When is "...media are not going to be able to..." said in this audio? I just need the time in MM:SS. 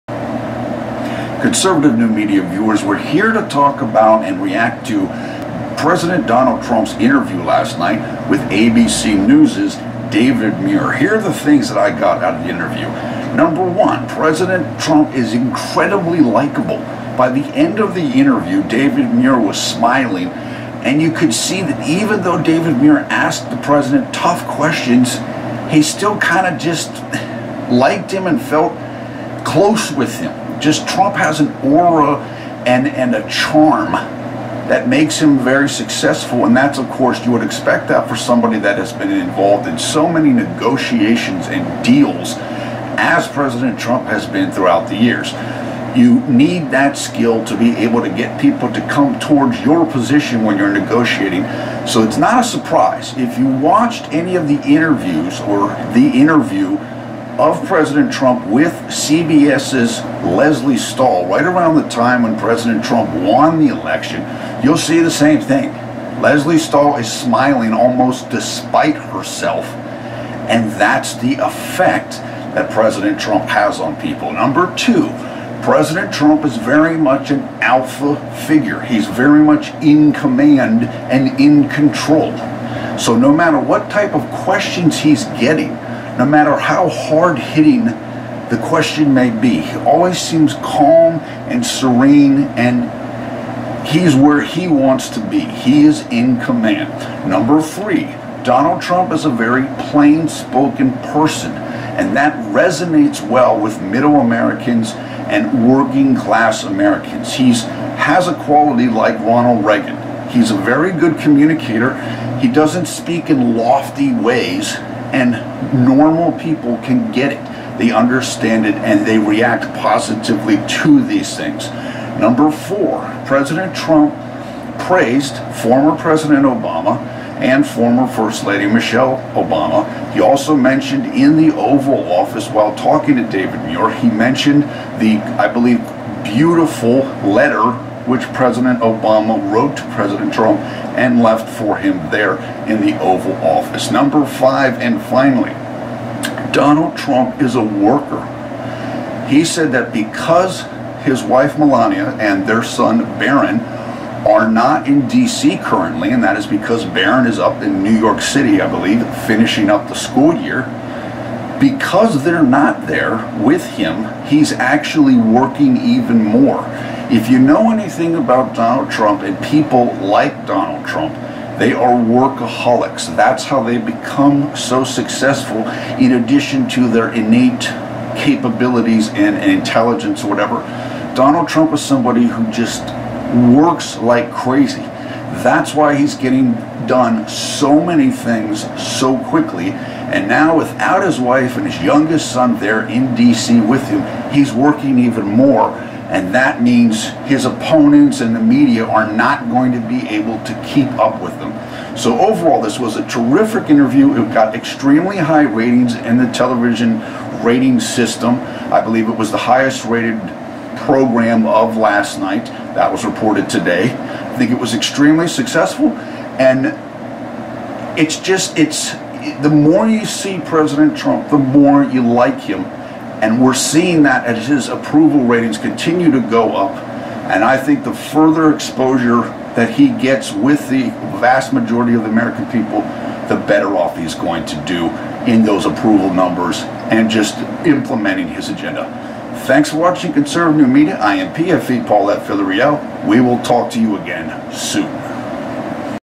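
03:18.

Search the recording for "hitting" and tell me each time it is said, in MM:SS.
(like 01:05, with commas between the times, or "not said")
01:27.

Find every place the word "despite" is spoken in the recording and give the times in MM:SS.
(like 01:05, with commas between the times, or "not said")
01:08.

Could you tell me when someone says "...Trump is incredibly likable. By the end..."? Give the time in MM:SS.
00:14.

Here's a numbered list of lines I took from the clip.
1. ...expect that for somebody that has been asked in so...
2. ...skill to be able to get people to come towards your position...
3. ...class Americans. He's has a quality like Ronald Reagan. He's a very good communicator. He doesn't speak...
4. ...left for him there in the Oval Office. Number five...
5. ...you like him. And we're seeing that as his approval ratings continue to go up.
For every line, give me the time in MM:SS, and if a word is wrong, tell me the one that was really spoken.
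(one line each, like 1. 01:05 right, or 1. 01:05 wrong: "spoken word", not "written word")
1. 00:37 wrong: "involved", not "asked"
2. 00:46 right
3. 01:46 right
4. 02:21 right
5. 03:41 right.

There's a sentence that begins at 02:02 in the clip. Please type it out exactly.
Number four, President Trump praised former President Obama and former First Lady Michelle Obama.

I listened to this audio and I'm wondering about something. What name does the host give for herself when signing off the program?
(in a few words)
Paulette Villarreal.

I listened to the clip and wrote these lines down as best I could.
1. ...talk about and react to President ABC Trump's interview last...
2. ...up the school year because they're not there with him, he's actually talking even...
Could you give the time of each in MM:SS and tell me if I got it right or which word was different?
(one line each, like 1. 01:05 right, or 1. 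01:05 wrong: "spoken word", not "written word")
1. 00:03 wrong: "Donald", not "ABC"
2. 02:39 wrong: "working", not "talking".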